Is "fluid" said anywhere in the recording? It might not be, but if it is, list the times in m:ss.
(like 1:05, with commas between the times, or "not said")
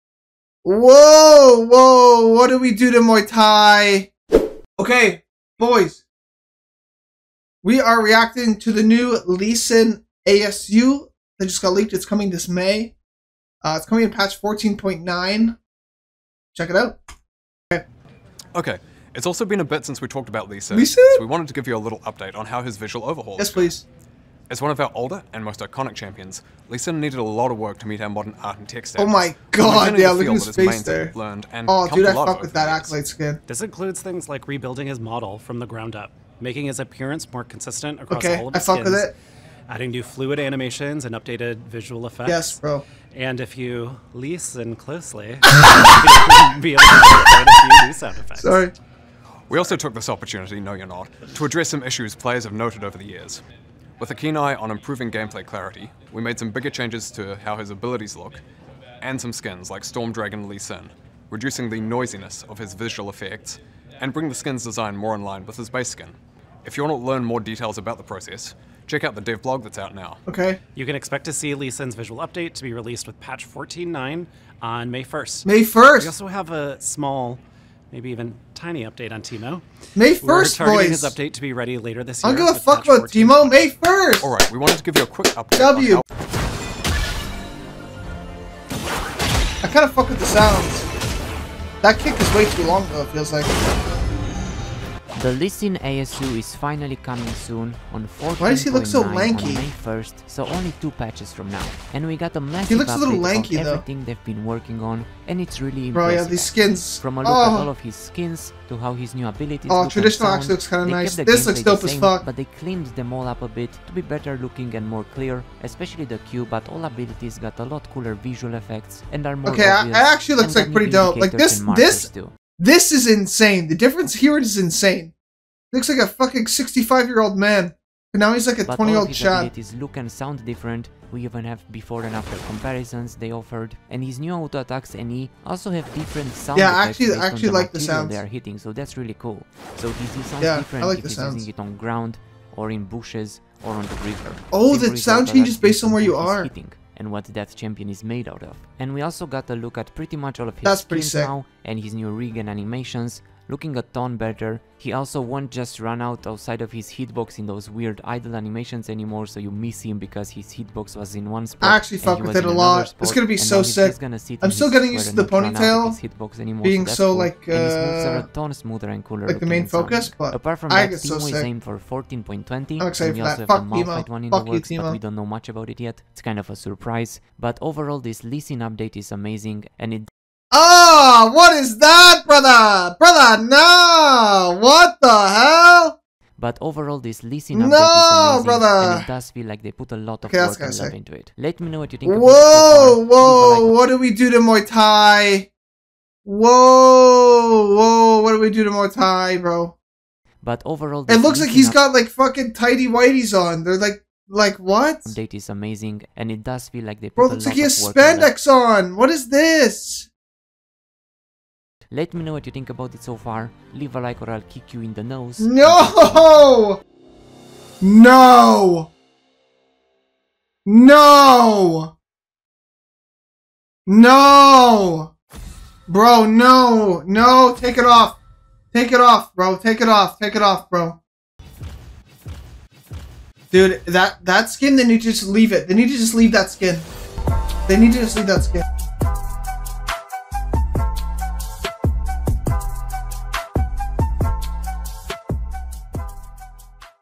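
0:40.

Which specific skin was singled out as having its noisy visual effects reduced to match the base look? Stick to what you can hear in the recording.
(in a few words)
Storm Dragon Lee Sin.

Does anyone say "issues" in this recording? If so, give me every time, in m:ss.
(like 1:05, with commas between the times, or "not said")
0:51.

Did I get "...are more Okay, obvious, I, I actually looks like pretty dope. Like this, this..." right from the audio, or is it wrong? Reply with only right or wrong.
right.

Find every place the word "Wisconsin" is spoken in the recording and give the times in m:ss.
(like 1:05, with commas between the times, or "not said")
not said.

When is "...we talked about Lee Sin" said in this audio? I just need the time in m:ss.
0:19.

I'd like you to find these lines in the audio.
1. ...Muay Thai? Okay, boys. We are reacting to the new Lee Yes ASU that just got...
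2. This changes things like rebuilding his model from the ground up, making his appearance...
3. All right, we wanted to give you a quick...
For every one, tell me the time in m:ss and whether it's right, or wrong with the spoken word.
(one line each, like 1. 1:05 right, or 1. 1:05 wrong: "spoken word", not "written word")
1. 0:02 wrong: "Sin", not "Yes"
2. 0:33 wrong: "includes", not "changes"
3. 1:24 right.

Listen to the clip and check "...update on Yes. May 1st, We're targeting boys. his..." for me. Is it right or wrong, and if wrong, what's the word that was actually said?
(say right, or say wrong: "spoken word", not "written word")
wrong: "Teemo", not "Yes".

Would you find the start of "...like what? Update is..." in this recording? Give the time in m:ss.
3:24.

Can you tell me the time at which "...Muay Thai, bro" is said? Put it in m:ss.
3:18.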